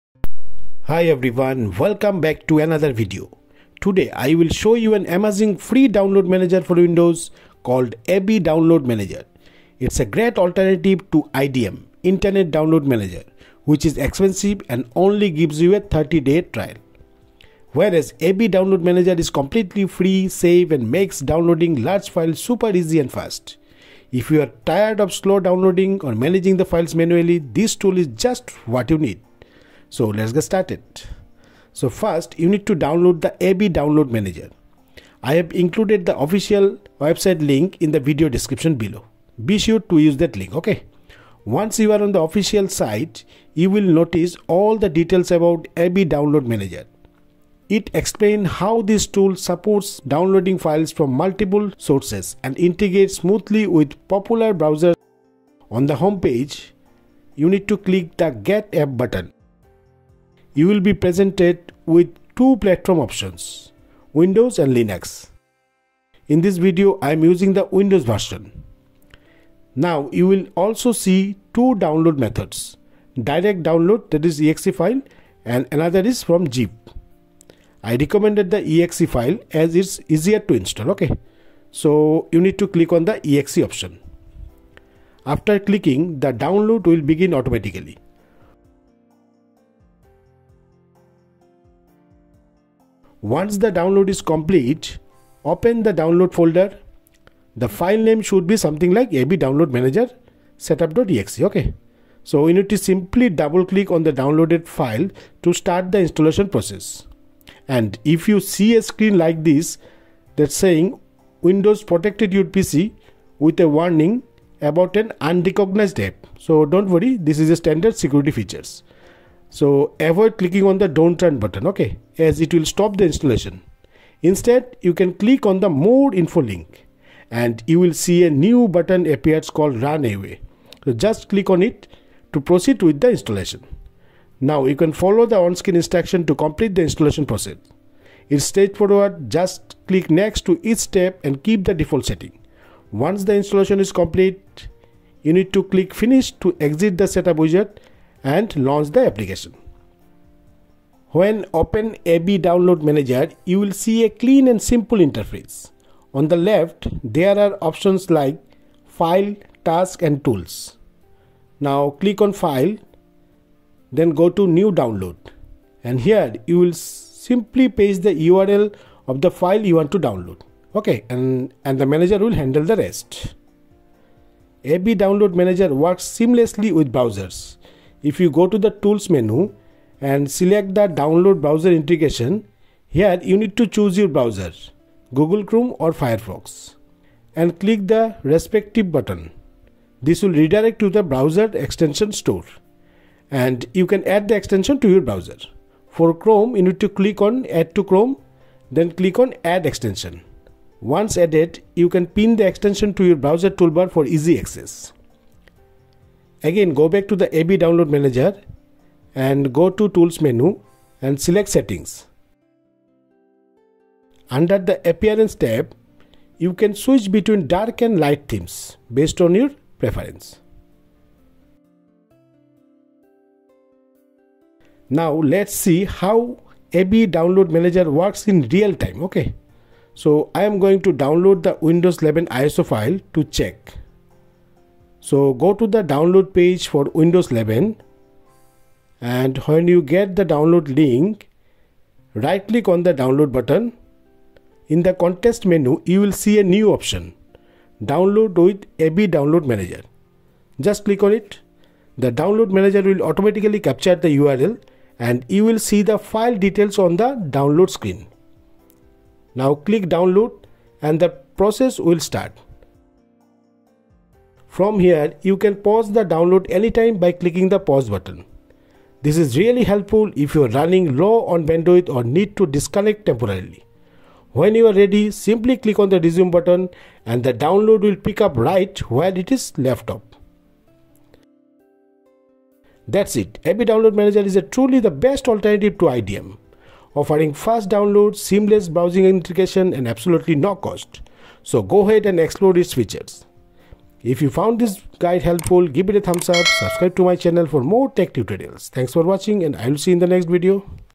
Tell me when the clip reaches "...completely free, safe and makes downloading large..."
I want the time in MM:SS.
00:19.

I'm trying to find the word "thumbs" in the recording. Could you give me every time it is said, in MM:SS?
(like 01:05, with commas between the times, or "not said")
04:56.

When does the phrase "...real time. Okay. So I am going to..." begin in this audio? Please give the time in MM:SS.
03:48.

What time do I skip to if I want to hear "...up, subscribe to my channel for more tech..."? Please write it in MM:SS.
04:56.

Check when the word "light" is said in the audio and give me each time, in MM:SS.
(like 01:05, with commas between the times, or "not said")
03:37.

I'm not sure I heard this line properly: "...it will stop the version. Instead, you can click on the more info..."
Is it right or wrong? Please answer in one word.
wrong.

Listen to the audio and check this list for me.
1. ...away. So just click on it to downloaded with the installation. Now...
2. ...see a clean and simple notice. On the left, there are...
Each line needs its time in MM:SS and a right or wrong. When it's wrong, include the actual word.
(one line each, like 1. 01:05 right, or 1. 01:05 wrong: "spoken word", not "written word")
1. 02:10 wrong: "proceed", not "downloaded"
2. 02:33 wrong: "interface", not "notice".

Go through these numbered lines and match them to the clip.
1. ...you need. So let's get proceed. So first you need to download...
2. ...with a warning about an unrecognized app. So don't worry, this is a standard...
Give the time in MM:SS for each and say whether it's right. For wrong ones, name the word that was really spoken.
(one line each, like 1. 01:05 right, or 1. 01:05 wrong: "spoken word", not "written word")
1. 00:28 wrong: "started", not "proceed"
2. 01:53 right.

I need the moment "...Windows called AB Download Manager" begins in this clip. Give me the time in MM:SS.
00:06.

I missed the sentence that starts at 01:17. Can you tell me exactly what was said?
I recommended the exe file as it's easier to install, okay.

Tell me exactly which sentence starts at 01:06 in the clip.
In this video, I am using the Windows version.